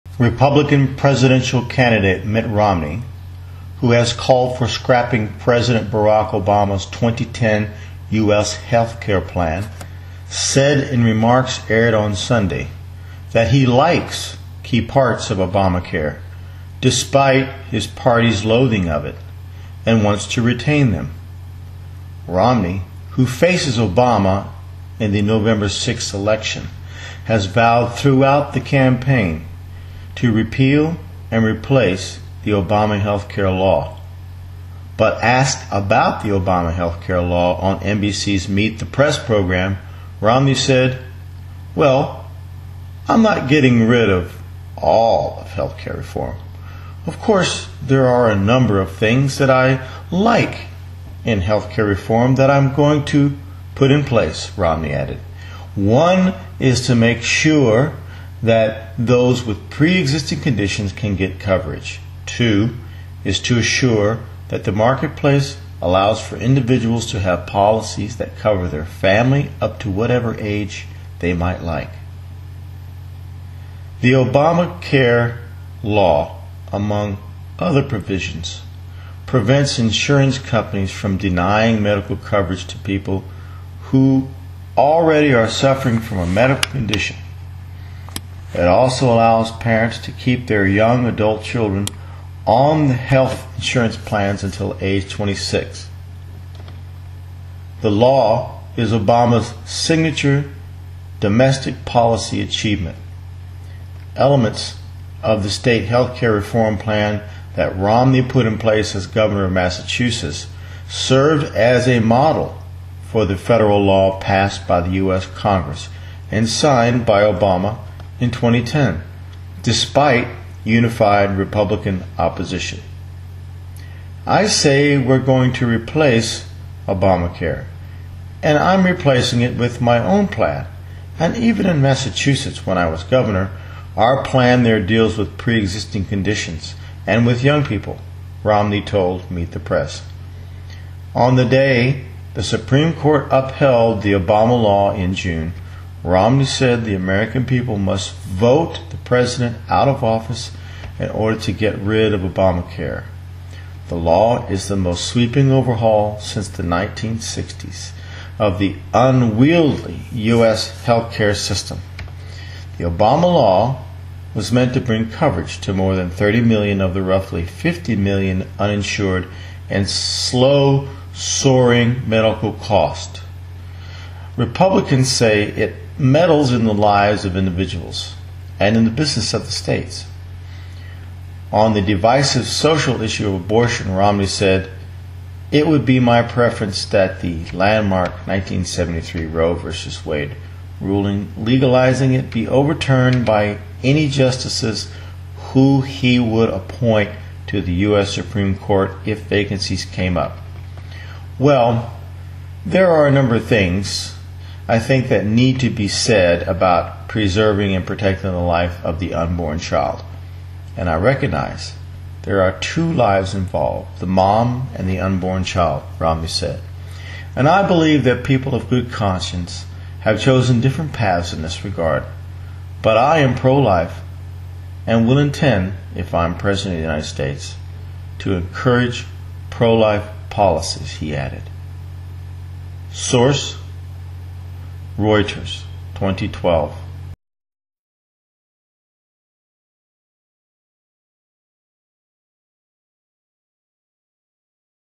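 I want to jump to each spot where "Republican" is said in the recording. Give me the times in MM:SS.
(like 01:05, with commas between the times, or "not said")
00:00, 02:01, 02:54.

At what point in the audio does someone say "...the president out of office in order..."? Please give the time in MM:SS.
02:28.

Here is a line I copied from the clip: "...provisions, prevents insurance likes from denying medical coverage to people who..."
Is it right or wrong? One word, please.
wrong.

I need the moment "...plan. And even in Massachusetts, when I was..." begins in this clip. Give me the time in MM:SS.
02:10.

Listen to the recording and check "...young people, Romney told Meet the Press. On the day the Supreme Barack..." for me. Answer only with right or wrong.
wrong.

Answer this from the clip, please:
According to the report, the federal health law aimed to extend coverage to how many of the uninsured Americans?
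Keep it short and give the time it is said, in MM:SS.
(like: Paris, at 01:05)
30 million, at 02:46.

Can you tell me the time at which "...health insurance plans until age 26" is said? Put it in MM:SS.
01:32.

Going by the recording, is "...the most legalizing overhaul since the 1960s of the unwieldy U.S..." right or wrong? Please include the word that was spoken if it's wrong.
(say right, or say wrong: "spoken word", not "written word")
wrong: "sweeping", not "legalizing".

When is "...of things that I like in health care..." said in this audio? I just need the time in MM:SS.
00:48.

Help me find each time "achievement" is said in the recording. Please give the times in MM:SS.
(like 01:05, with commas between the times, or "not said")
01:42.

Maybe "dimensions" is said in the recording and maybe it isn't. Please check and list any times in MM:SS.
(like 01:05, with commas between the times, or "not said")
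not said.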